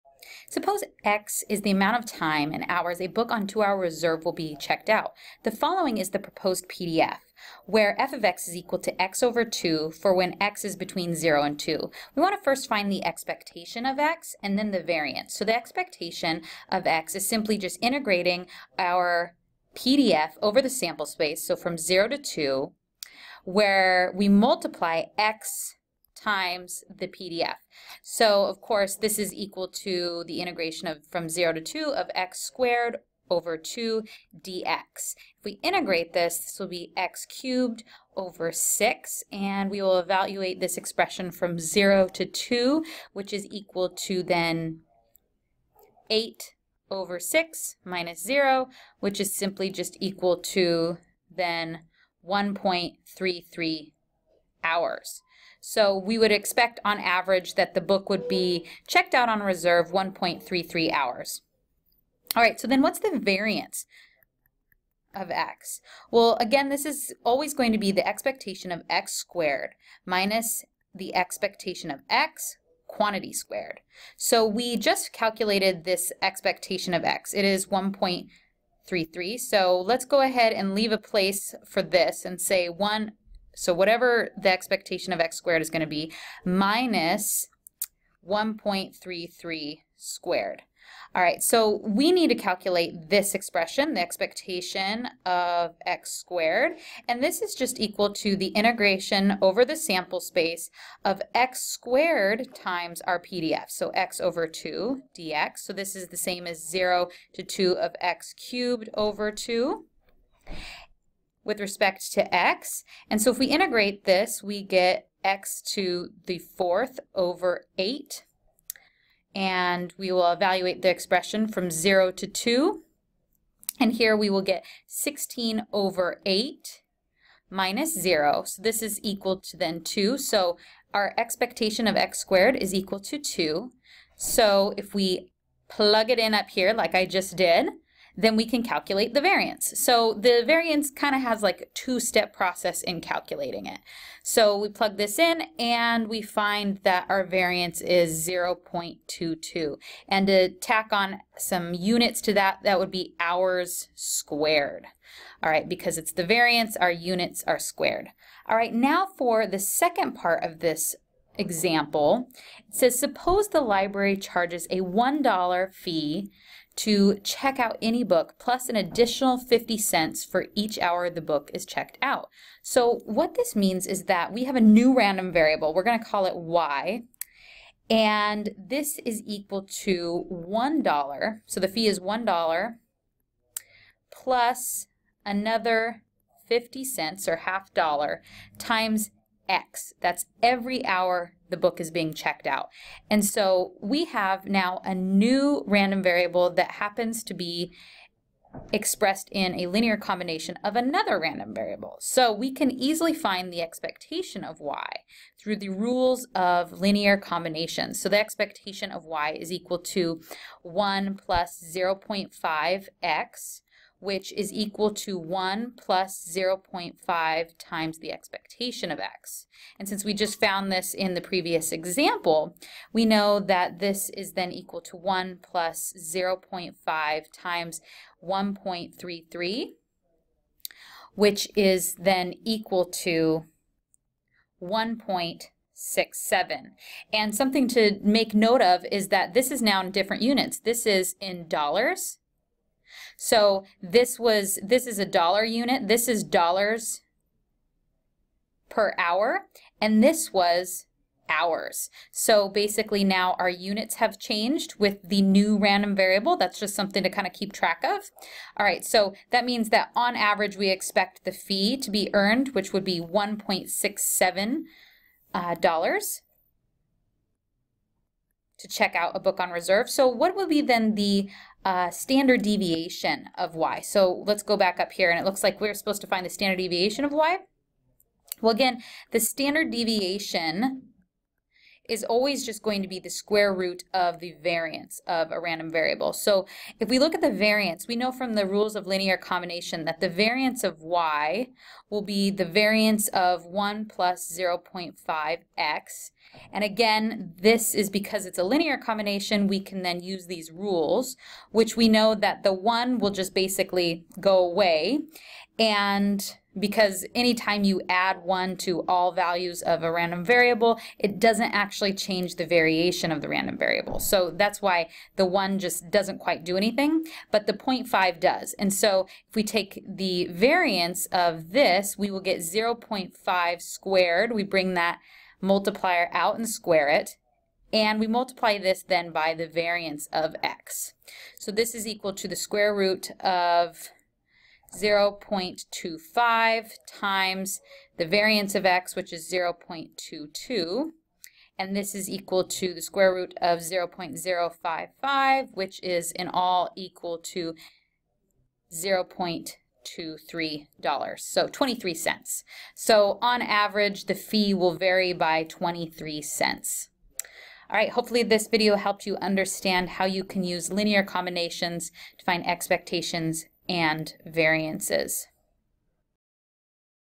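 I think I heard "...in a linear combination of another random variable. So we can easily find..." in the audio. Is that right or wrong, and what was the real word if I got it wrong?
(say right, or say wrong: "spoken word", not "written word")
right.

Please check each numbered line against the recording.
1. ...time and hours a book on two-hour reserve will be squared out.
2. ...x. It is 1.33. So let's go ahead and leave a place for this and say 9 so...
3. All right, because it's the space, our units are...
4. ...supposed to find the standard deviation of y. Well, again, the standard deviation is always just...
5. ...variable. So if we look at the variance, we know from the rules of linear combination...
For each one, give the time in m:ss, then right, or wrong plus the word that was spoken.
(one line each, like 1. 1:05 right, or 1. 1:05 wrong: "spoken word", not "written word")
1. 0:02 wrong: "checked", not "squared"
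2. 1:17 wrong: "1", not "9"
3. 2:35 wrong: "variance", not "space"
4. 4:35 right
5. 4:45 right.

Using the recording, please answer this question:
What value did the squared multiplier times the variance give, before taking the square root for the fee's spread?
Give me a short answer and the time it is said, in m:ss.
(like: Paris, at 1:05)
0.055, at 5:43.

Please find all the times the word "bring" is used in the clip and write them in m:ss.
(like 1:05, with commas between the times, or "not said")
5:24.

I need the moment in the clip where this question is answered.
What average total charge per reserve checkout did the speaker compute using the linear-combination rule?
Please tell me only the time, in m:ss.
4:22.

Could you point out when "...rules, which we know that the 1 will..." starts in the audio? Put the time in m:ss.
5:00.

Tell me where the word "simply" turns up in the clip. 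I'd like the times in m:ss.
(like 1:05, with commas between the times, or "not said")
0:17, 0:49.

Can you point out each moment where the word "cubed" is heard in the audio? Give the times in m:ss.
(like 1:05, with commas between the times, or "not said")
0:37, 1:48.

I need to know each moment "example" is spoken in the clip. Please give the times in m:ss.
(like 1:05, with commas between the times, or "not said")
2:41, 3:41.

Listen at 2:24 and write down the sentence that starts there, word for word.
So we plug this in and we find that our variance is 0.22.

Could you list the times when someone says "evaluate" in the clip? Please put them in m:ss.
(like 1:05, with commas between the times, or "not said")
0:39, 2:00.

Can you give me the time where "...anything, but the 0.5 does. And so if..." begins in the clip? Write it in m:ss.
5:16.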